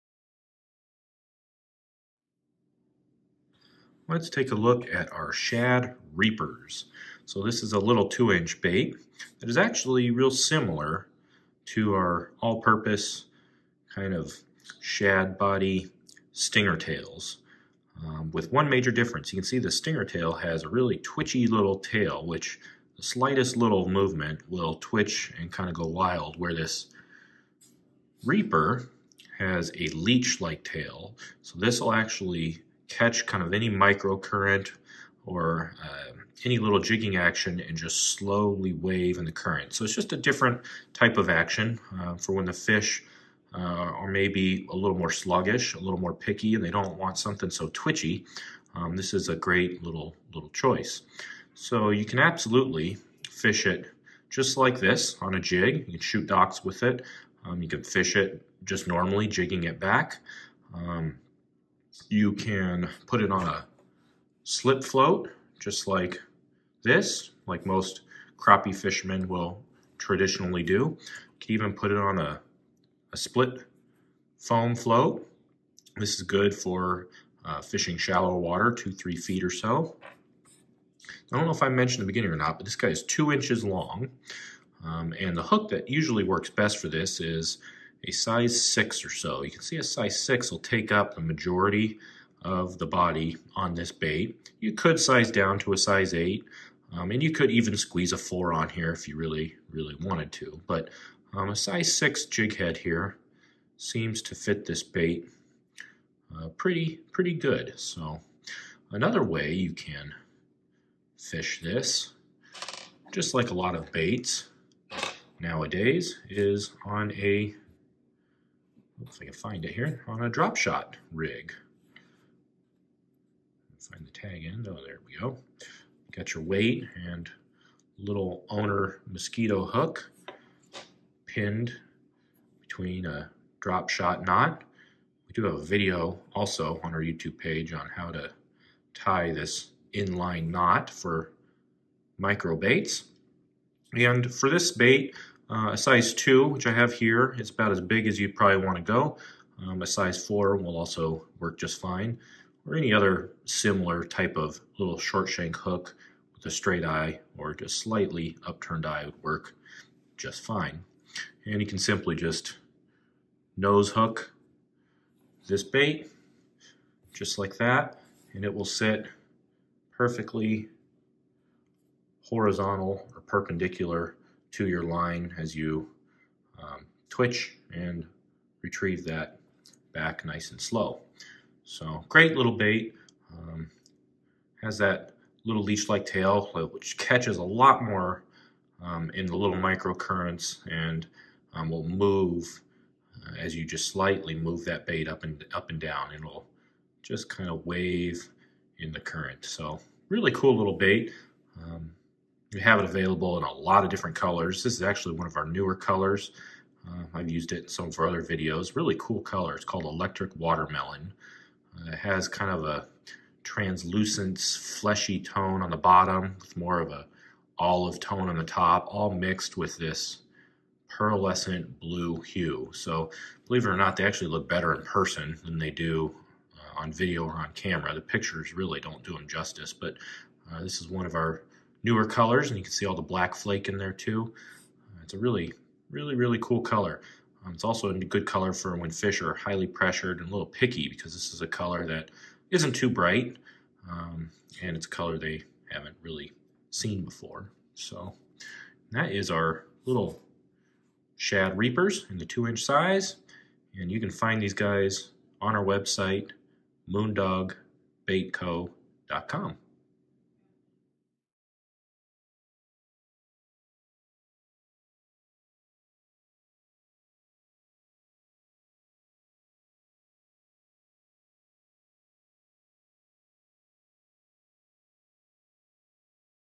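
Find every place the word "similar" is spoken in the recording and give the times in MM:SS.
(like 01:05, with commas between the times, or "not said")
00:10, 02:33.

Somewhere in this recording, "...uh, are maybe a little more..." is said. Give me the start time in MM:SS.
00:43.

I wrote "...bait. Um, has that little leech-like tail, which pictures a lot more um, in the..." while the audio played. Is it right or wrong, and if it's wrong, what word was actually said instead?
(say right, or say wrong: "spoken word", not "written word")
wrong: "catches", not "pictures".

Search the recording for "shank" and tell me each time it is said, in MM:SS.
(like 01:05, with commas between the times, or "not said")
02:35.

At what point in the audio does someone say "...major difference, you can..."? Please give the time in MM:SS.
00:18.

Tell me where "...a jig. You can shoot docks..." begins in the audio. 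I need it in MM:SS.
00:55.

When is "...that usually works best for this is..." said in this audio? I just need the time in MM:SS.
01:25.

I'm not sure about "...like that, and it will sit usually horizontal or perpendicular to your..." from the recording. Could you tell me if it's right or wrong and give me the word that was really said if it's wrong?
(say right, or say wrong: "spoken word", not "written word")
wrong: "perfectly", not "usually".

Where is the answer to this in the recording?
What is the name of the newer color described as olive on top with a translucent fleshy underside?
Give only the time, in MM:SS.
03:29.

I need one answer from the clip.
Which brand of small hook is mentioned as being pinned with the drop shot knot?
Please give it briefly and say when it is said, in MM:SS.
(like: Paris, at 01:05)
Owner Mosquito, at 02:08.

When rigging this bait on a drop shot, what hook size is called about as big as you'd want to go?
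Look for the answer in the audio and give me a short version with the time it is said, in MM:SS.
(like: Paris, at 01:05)
2, at 02:25.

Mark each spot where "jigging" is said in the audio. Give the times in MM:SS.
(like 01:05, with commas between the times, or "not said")
00:36, 00:59.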